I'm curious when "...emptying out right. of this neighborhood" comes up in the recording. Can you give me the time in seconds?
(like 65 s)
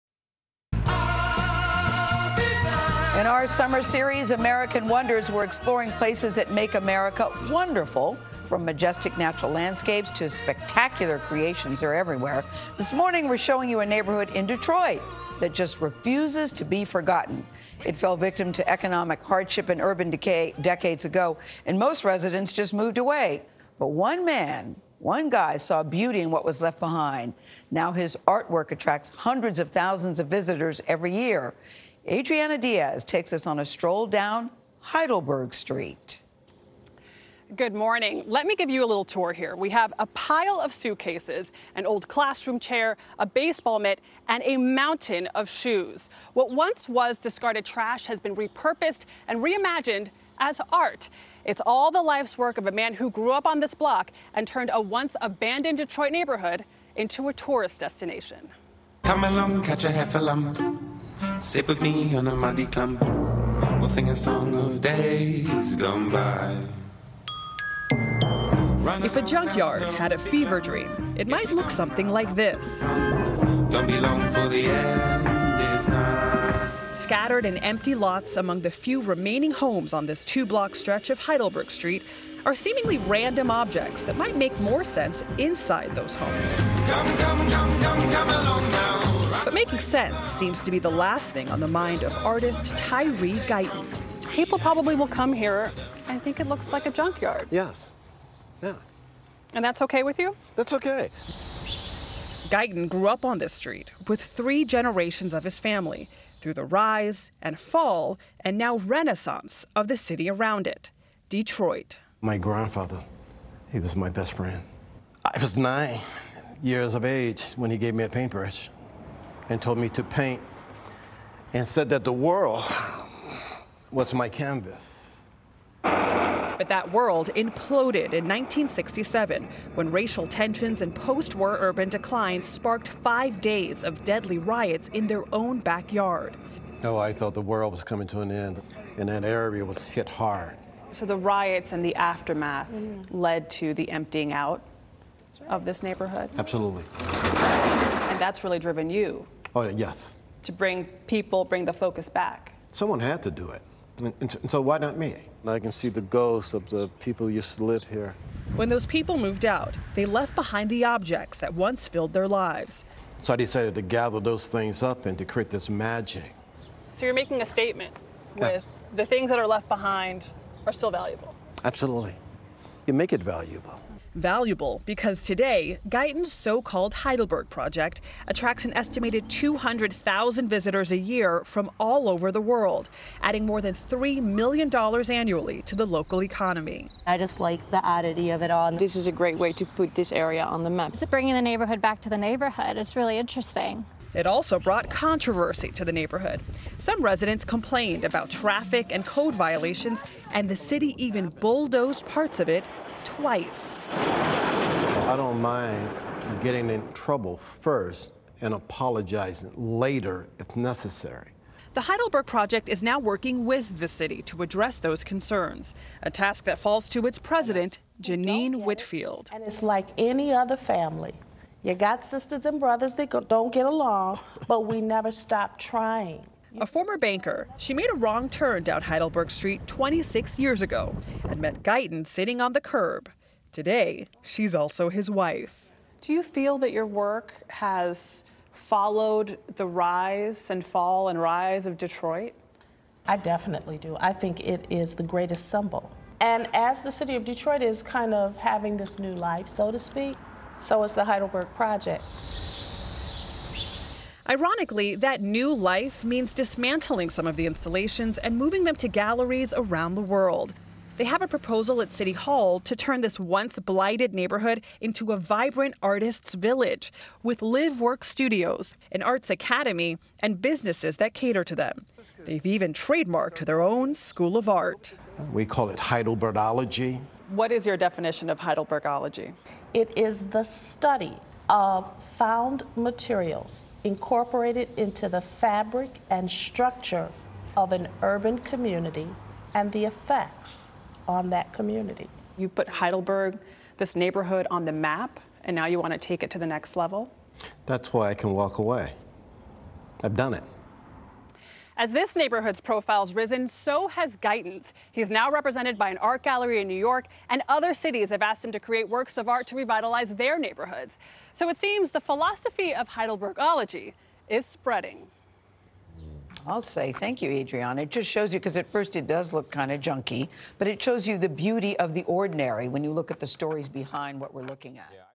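143 s.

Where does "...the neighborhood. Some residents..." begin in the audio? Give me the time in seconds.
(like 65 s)
195 s.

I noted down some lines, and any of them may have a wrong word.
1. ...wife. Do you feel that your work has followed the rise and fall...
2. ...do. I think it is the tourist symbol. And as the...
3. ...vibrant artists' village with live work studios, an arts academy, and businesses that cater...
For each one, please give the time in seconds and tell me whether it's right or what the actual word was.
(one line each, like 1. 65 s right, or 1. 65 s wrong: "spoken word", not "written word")
1. 235 s right
2. 243 s wrong: "greatest", not "tourist"
3. 265 s right.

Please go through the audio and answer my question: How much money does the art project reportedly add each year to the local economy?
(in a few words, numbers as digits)
More than $3 million.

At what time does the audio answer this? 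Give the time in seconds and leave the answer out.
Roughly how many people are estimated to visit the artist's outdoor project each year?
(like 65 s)
179 s.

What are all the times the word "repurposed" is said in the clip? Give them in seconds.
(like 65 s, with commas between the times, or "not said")
48 s.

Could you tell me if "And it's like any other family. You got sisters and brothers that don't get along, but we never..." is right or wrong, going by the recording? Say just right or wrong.
right.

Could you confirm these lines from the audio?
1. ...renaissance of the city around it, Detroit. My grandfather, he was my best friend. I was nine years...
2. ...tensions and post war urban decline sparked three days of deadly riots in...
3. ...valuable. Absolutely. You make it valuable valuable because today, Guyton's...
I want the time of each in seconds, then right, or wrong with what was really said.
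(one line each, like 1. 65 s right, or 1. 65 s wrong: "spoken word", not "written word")
1. 108 s right
2. 130 s wrong: "five", not "three"
3. 170 s right.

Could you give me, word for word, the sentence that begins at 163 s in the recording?
So I decided to gather those things up and to create this magic.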